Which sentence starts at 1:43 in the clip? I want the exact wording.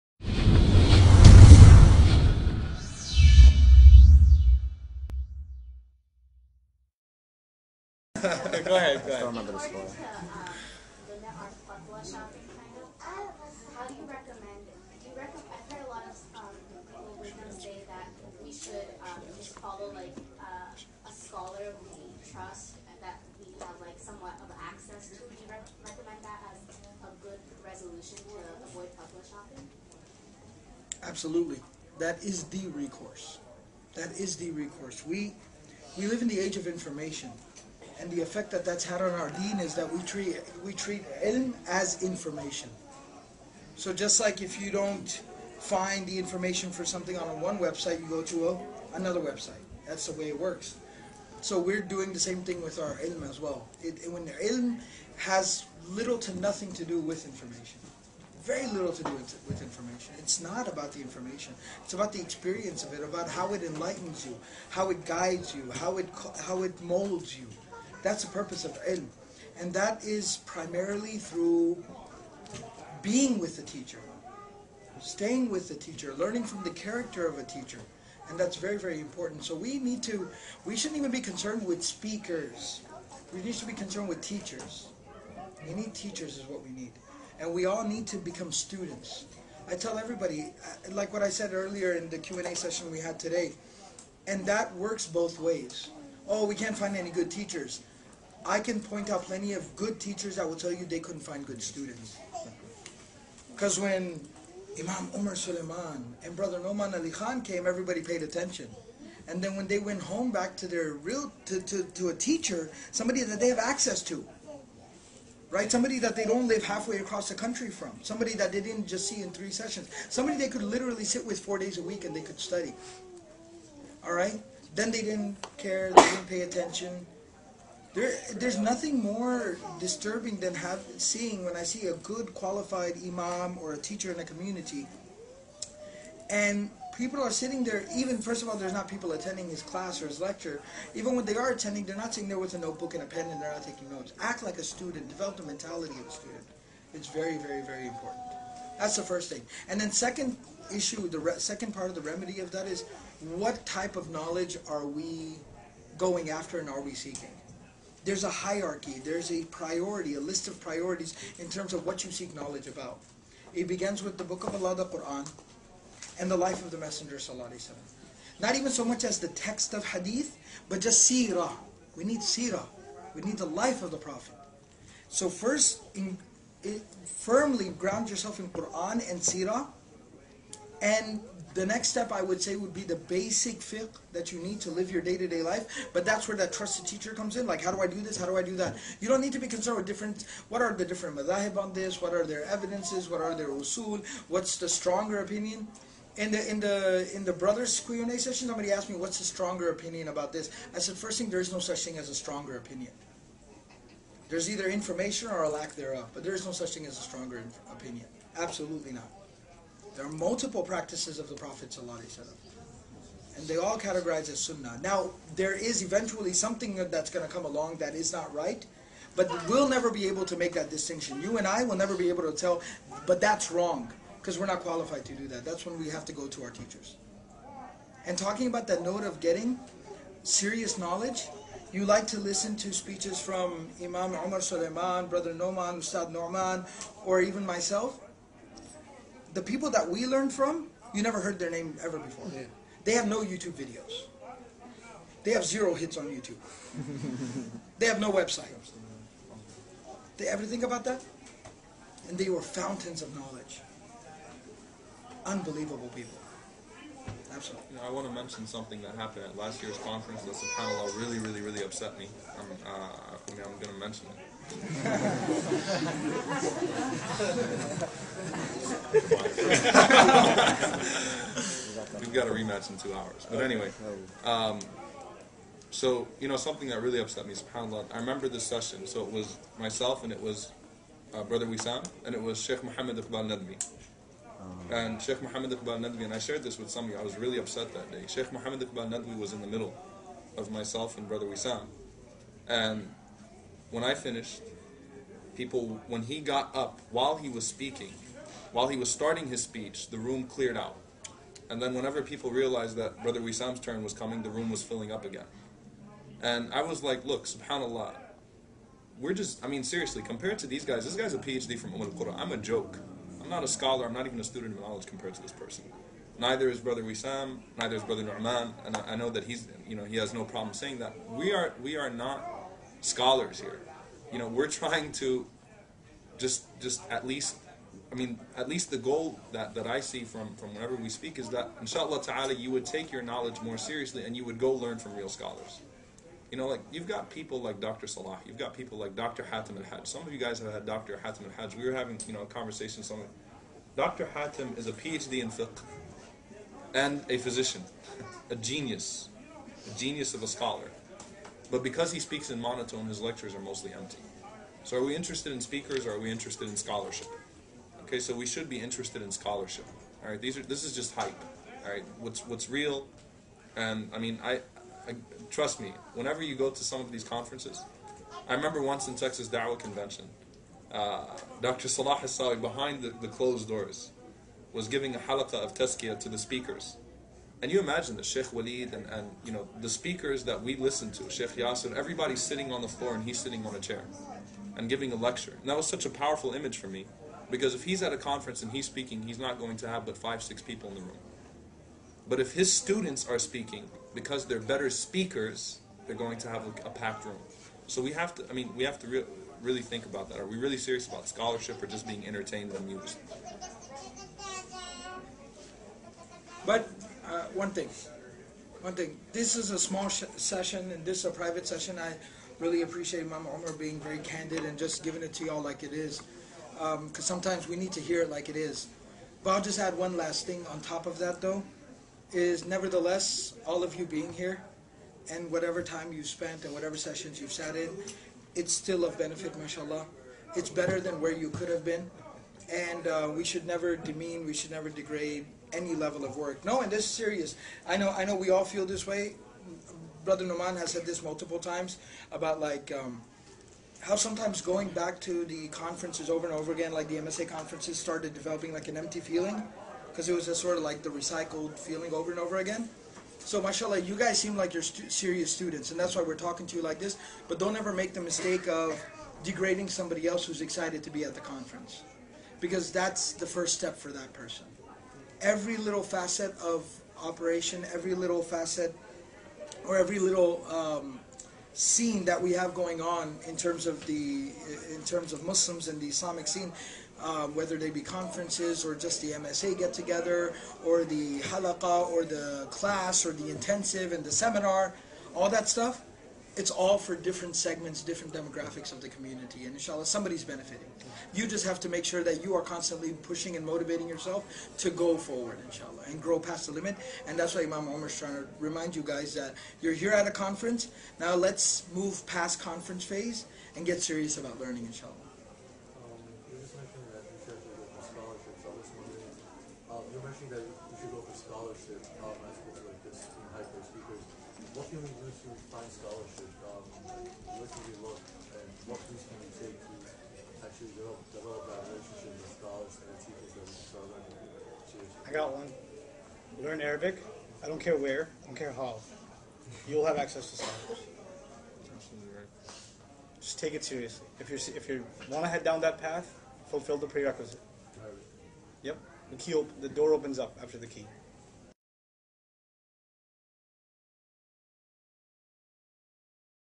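Because when Imam Omar Suleiman and Brother Nouman Ali Khan came, everybody paid attention.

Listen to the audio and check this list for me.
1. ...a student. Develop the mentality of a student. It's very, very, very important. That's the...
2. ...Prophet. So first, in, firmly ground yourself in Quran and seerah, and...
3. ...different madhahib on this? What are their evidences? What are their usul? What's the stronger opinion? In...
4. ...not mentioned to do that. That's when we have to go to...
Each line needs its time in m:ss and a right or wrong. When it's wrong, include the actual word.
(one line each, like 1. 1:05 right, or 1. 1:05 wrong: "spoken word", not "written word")
1. 2:24 right
2. 2:53 right
3. 3:10 right
4. 3:44 wrong: "qualified", not "mentioned".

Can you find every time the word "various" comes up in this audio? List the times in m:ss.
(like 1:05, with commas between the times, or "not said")
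not said.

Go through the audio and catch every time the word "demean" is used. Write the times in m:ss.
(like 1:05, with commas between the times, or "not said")
7:13.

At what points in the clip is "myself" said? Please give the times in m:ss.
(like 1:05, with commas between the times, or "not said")
3:57, 4:39, 4:50.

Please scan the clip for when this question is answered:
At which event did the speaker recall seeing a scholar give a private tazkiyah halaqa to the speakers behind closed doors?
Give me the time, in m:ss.
6:08.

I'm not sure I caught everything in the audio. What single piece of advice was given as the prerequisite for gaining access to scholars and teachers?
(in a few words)
Learn Arabic.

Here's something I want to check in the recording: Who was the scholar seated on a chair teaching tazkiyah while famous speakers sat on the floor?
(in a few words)
Dr. Salah Hassawi.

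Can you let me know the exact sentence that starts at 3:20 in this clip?
I said, first thing, there is no such thing as a stronger opinion.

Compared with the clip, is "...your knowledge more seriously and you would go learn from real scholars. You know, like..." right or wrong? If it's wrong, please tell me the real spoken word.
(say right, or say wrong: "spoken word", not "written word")
right.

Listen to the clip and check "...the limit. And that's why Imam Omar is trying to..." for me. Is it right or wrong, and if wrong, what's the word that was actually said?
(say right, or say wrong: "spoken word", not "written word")
right.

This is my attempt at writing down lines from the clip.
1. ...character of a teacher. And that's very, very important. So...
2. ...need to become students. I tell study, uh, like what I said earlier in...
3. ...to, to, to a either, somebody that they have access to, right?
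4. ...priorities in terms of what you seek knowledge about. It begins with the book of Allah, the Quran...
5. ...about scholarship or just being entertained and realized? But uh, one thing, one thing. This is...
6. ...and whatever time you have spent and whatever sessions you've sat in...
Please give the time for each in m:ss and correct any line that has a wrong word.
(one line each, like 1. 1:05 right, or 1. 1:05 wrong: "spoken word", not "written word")
1. 1:16 right
2. 1:27 wrong: "everybody", not "study"
3. 1:51 wrong: "teacher", not "either"
4. 2:40 right
5. 6:40 wrong: "amused", not "realized"
6. 7:05 right.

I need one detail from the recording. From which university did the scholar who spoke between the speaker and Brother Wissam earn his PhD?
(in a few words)
Umm al-Qura.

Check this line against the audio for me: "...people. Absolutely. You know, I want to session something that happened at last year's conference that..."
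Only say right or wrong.
wrong.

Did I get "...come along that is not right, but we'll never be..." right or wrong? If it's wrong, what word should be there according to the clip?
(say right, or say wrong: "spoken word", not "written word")
right.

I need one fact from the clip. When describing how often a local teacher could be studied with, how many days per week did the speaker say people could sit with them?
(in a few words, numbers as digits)
4.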